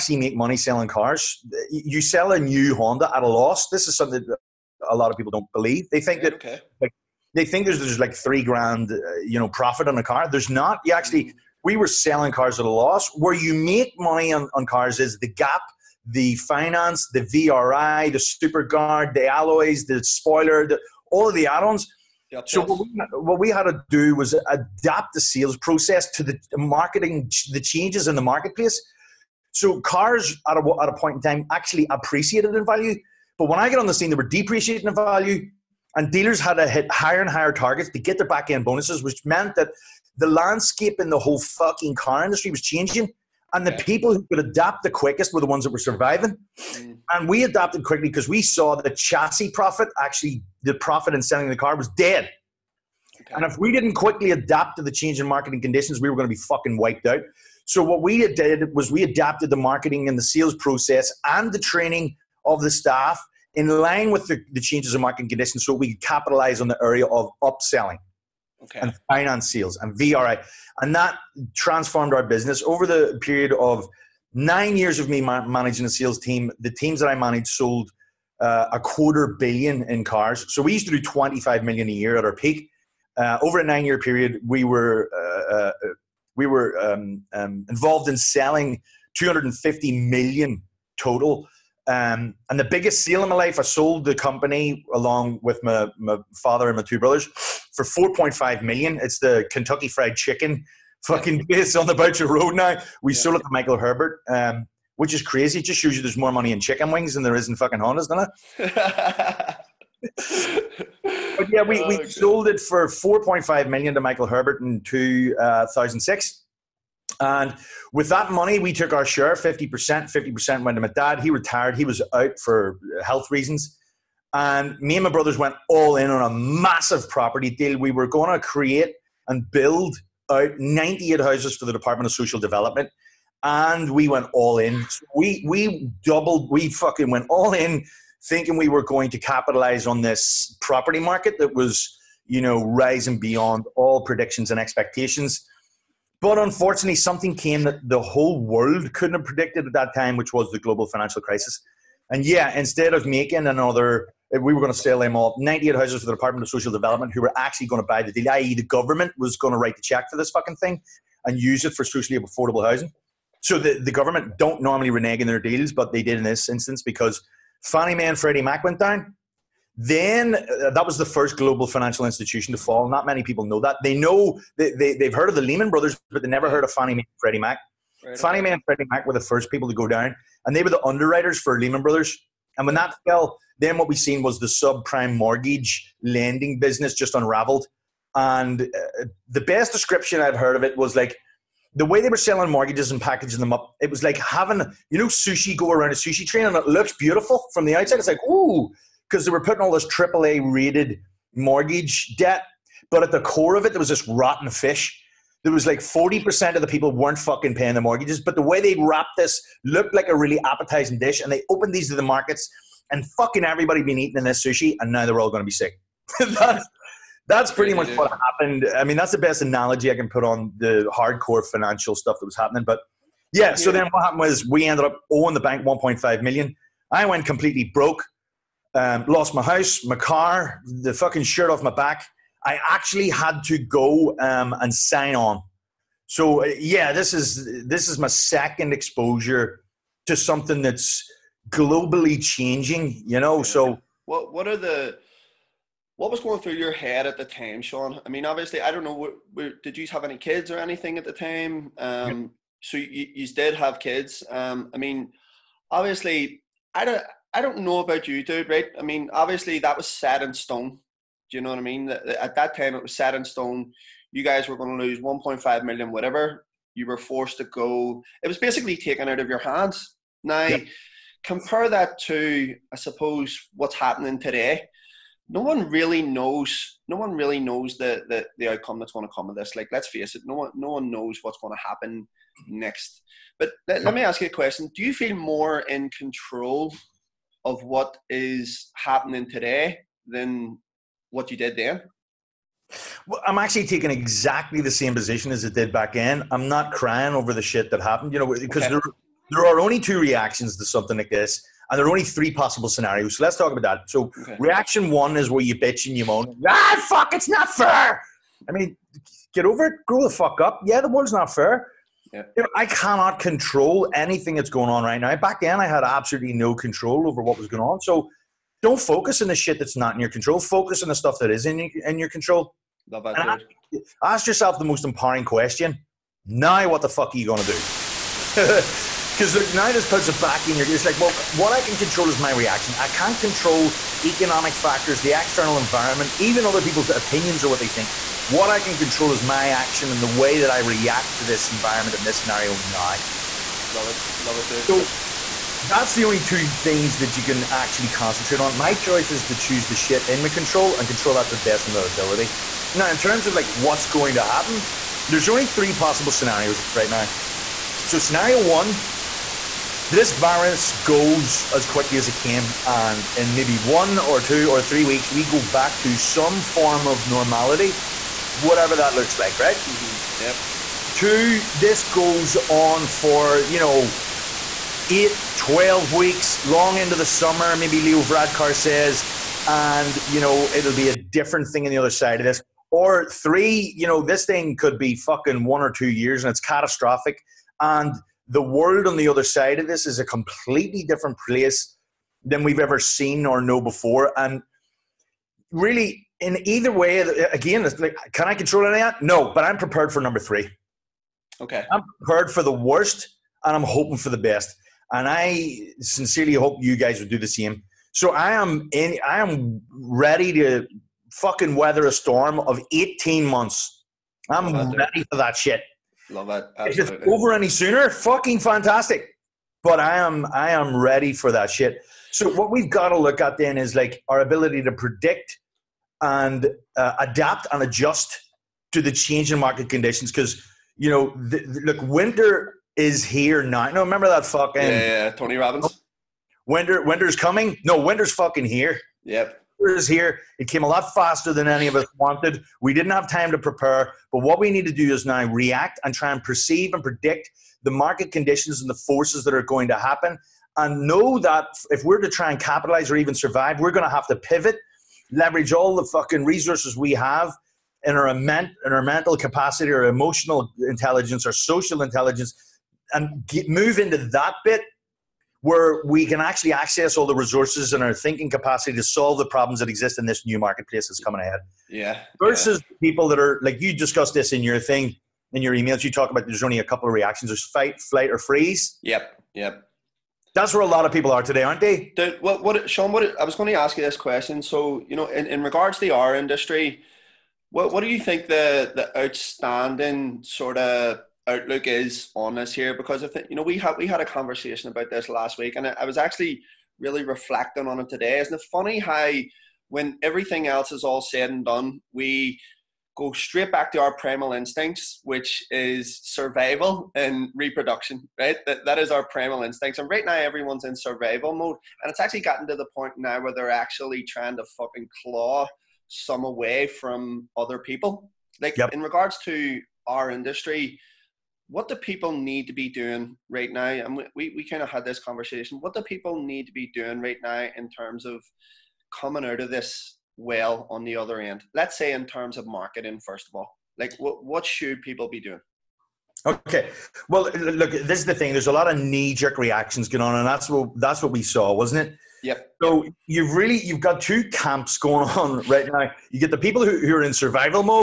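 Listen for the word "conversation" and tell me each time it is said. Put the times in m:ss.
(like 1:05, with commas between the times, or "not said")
8:14, 8:44.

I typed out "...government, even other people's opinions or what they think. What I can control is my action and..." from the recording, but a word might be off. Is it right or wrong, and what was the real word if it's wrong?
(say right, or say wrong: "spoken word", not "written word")
wrong: "environment", not "government".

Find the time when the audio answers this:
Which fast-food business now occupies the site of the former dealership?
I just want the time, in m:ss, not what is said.
1:39.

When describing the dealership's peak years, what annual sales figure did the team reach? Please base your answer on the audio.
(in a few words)
25 million.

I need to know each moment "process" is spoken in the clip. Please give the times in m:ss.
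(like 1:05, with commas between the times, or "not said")
0:25, 1:00.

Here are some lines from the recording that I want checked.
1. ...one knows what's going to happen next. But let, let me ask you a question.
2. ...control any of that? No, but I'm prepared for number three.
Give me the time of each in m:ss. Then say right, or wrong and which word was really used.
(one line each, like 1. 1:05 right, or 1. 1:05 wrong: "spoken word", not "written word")
1. 4:40 right
2. 6:38 right.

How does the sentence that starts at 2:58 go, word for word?
Right Fannie Mae and Freddie Mac were the first people to go down, and they were the underwriters for Lehman Brothers.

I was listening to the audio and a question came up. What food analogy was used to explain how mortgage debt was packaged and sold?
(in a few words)
sushi train.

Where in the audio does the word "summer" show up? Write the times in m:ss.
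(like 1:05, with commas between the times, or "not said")
6:17.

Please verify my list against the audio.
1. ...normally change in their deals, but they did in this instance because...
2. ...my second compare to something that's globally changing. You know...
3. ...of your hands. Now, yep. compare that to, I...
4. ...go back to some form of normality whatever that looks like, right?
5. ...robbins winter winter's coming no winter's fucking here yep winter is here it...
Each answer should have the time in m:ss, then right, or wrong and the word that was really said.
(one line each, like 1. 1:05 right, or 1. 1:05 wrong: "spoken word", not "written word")
1. 2:44 wrong: "renege", not "change"
2. 3:57 wrong: "exposure", not "compare"
3. 4:29 right
4. 6:05 right
5. 7:15 right.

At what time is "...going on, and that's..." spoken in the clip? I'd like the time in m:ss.
8:59.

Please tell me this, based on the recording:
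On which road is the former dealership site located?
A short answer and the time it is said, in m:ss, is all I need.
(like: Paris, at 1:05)
Boucher Road, at 1:41.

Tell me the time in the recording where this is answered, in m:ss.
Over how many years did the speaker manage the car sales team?
1:14.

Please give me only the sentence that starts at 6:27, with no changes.
And the world on the other side of this is a completely different place than we've ever seen or know before.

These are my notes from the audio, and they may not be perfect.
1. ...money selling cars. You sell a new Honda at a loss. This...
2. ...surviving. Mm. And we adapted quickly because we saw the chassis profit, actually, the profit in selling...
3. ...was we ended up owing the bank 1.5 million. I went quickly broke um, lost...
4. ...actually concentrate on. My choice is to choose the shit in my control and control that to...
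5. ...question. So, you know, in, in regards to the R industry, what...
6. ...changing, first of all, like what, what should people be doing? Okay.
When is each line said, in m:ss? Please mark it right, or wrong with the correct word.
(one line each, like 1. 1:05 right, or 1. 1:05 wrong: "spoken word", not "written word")
1. 0:00 right
2. 0:45 right
3. 3:44 wrong: "completely", not "quickly"
4. 5:47 right
5. 8:03 right
6. 8:52 wrong: "marketing", not "changing".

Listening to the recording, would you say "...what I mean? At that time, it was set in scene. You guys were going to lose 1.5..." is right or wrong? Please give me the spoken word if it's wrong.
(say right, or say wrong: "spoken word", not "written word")
wrong: "stone", not "scene".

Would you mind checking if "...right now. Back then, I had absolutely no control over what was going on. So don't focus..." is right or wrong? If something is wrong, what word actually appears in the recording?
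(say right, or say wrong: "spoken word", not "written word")
right.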